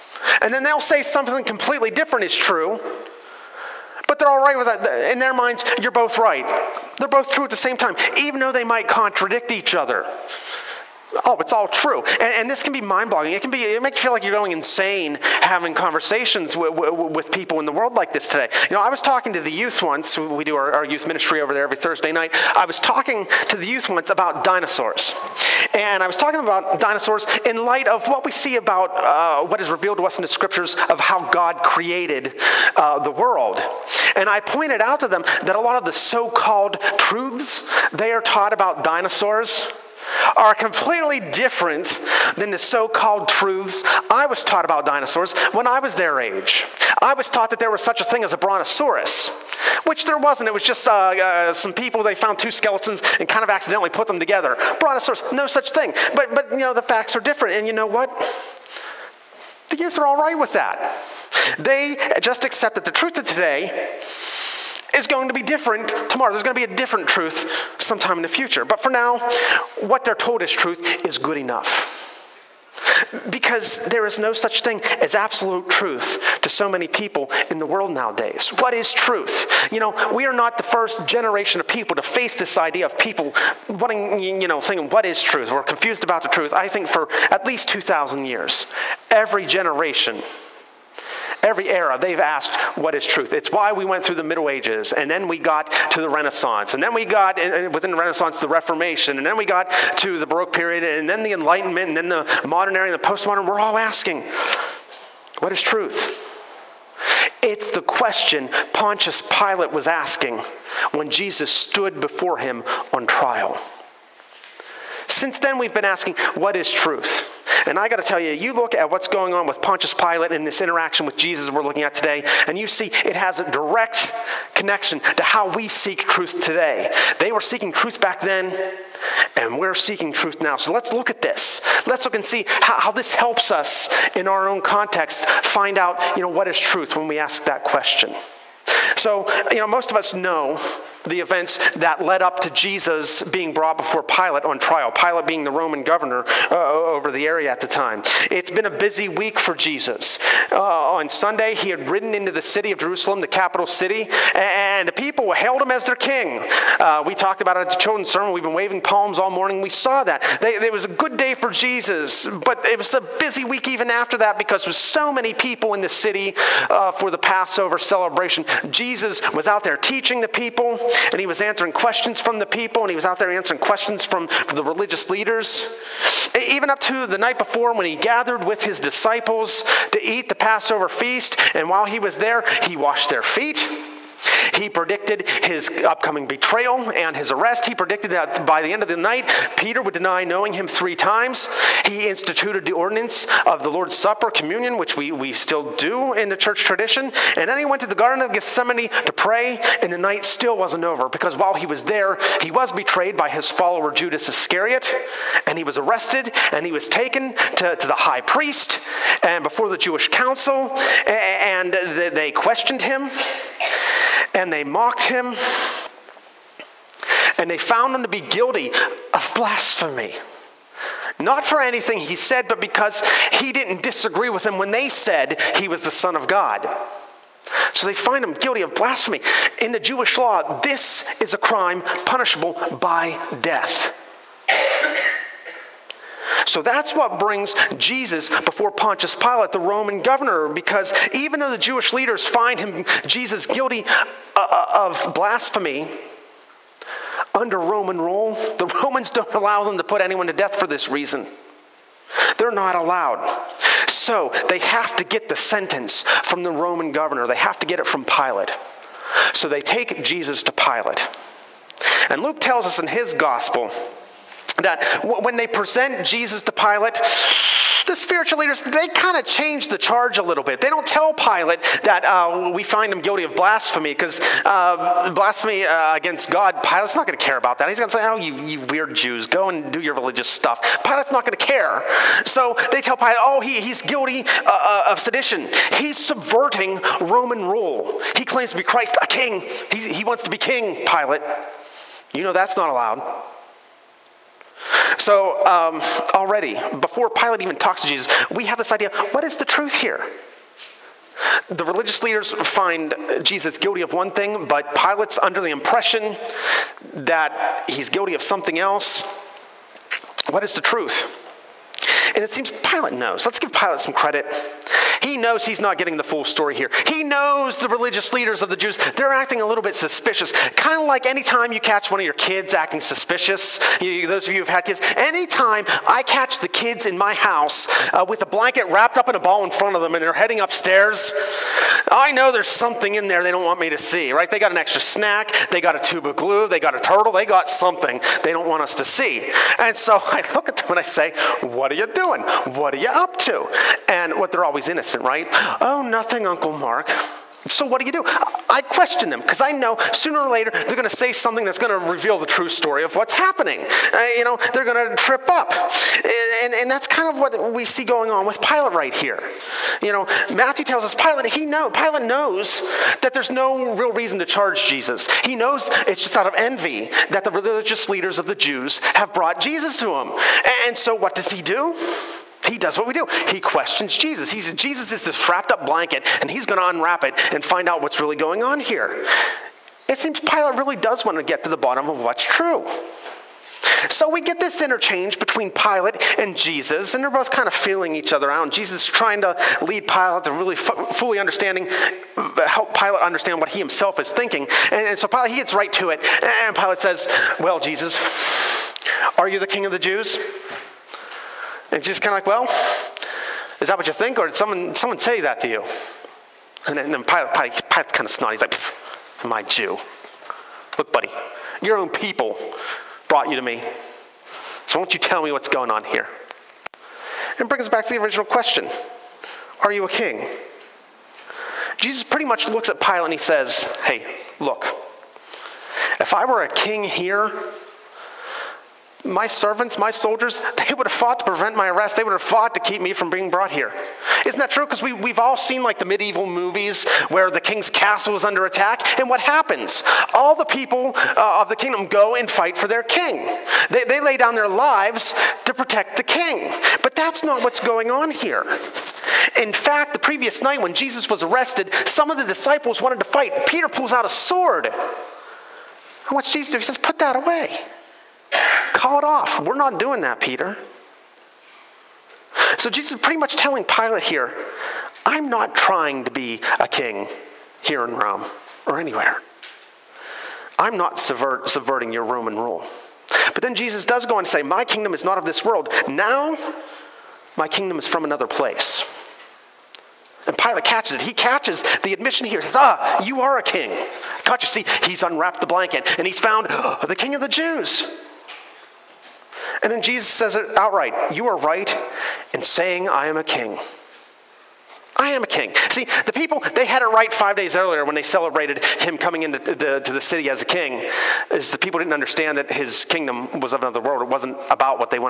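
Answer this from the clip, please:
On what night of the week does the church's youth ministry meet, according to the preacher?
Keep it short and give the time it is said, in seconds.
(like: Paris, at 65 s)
Thursday, at 21 s.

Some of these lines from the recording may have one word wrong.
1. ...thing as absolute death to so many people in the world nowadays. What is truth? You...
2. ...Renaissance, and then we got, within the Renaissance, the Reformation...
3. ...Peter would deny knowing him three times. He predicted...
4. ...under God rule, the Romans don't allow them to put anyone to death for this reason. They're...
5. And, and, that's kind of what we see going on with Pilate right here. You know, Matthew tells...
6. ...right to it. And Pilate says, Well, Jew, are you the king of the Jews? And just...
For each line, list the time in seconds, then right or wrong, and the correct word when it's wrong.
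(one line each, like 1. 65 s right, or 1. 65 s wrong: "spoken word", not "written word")
1. 74 s wrong: "truth", not "death"
2. 96 s right
3. 189 s wrong: "instituted", not "predicted"
4. 247 s wrong: "Roman", not "God"
5. 356 s right
6. 395 s wrong: "Jesus", not "Jew".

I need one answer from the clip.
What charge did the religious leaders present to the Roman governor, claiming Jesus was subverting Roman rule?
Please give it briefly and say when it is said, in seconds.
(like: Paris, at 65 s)
sedition, at 284 s.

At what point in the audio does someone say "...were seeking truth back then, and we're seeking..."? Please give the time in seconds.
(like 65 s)
127 s.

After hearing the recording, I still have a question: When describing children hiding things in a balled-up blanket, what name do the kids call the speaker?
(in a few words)
Uncle Mark.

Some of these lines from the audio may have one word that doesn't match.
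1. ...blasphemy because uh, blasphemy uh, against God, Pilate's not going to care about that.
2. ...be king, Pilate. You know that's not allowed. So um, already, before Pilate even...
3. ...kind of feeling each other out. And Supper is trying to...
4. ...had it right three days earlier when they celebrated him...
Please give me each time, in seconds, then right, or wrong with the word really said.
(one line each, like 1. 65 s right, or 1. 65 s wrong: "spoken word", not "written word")
1. 273 s right
2. 290 s right
3. 387 s wrong: "Jesus", not "Supper"
4. 496 s wrong: "five", not "three".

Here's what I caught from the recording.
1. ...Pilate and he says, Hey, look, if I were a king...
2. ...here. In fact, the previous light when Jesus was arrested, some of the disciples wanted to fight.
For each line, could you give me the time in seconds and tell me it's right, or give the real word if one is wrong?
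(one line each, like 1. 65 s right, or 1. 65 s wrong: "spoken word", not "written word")
1. 422 s right
2. 448 s wrong: "night", not "light".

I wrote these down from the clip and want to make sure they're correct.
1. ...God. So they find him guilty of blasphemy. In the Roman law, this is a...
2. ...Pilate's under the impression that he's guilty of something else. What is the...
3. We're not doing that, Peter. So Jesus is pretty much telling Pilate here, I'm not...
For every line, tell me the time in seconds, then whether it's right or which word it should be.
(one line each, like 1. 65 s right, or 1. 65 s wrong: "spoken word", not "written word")
1. 226 s wrong: "Jewish", not "Roman"
2. 304 s right
3. 459 s right.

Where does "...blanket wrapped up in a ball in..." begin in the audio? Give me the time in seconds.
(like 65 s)
328 s.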